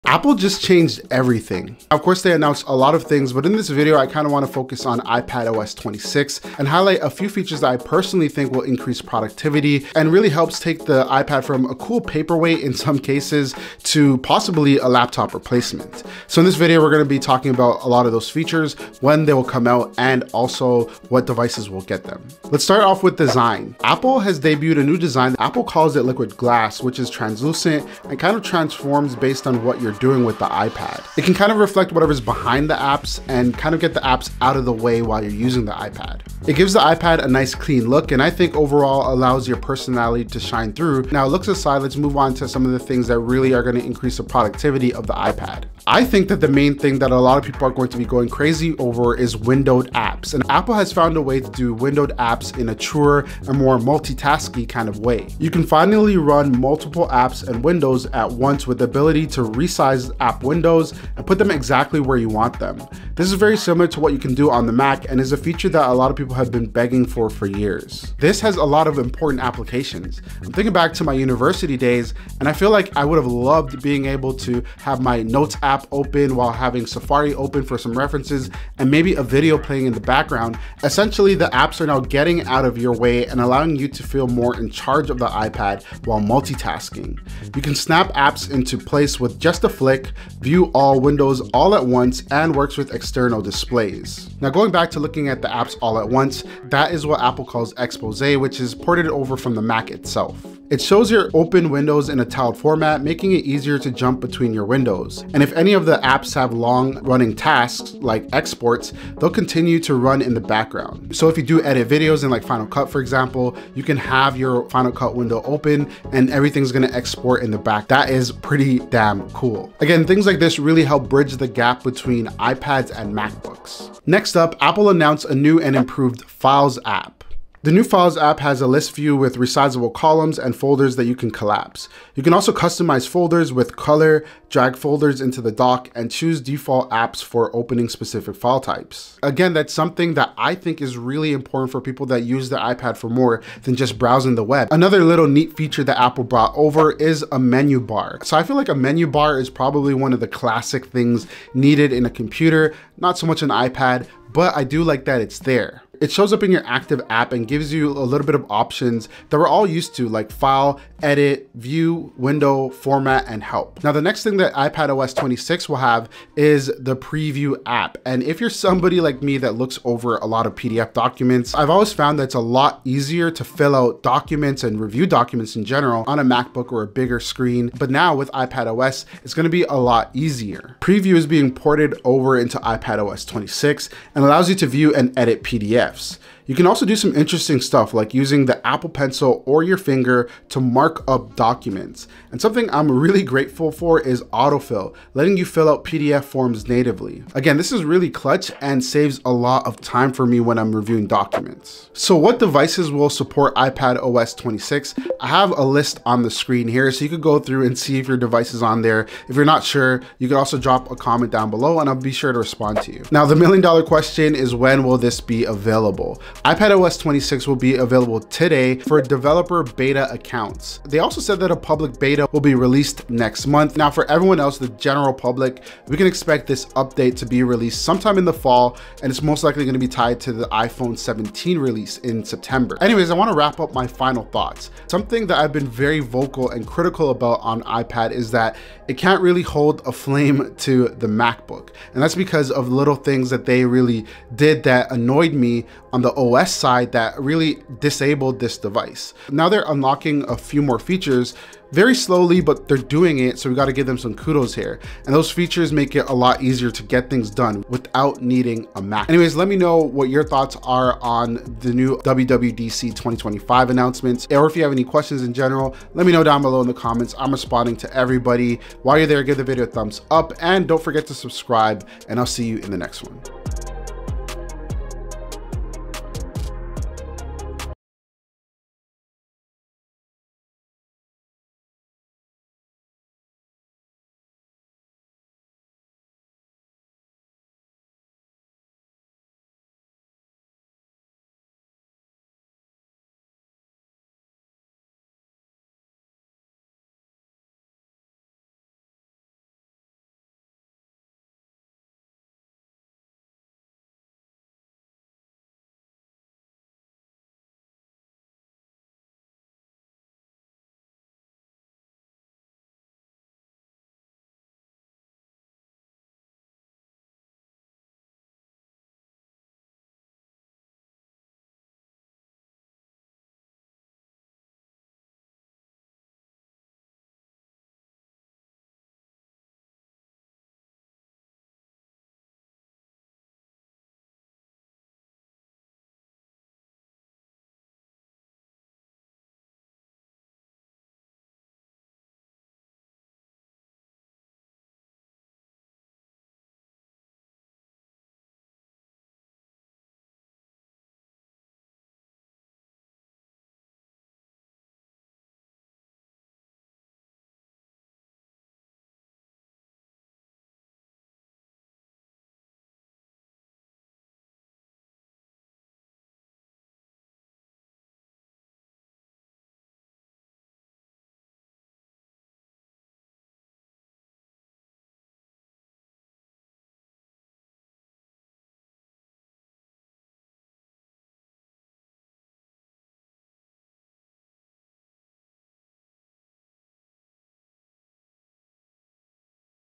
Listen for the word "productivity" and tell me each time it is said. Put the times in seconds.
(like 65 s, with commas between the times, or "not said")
9 s, 44 s.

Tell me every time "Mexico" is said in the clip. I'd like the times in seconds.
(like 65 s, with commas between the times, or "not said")
not said.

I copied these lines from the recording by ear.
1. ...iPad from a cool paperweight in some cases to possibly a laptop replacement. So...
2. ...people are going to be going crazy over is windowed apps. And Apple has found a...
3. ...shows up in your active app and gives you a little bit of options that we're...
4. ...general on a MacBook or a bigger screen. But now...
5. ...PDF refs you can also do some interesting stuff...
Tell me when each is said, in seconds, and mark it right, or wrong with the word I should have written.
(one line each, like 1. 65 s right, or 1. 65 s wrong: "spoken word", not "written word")
1. 11 s right
2. 47 s right
3. 156 s right
4. 175 s right
5. 185 s right.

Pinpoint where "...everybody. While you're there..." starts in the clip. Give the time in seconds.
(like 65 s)
267 s.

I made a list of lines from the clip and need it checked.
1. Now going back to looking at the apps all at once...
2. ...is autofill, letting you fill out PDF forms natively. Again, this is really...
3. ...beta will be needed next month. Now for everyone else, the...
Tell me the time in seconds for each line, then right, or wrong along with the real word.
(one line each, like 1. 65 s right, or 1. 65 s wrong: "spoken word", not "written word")
1. 94 s right
2. 194 s right
3. 221 s wrong: "released", not "needed".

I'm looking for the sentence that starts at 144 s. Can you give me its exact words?
Another little neat feature that Apple brought over is a menu bar.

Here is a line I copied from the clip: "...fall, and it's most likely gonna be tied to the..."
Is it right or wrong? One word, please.
right.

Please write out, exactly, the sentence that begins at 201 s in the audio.
So what devices will support iPad OS 26?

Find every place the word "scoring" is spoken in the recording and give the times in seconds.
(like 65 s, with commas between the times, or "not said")
not said.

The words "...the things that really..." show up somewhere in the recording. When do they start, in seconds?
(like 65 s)
42 s.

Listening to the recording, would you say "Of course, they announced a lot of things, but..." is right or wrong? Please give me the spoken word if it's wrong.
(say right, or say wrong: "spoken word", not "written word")
right.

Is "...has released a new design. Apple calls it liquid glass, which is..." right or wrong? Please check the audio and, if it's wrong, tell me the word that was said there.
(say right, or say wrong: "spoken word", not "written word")
wrong: "debuted", not "released".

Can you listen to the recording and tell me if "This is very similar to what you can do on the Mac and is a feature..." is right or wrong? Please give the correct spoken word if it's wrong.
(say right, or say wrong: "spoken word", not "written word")
right.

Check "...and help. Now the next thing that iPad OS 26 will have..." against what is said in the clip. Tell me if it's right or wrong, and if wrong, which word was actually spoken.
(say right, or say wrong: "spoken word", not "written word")
right.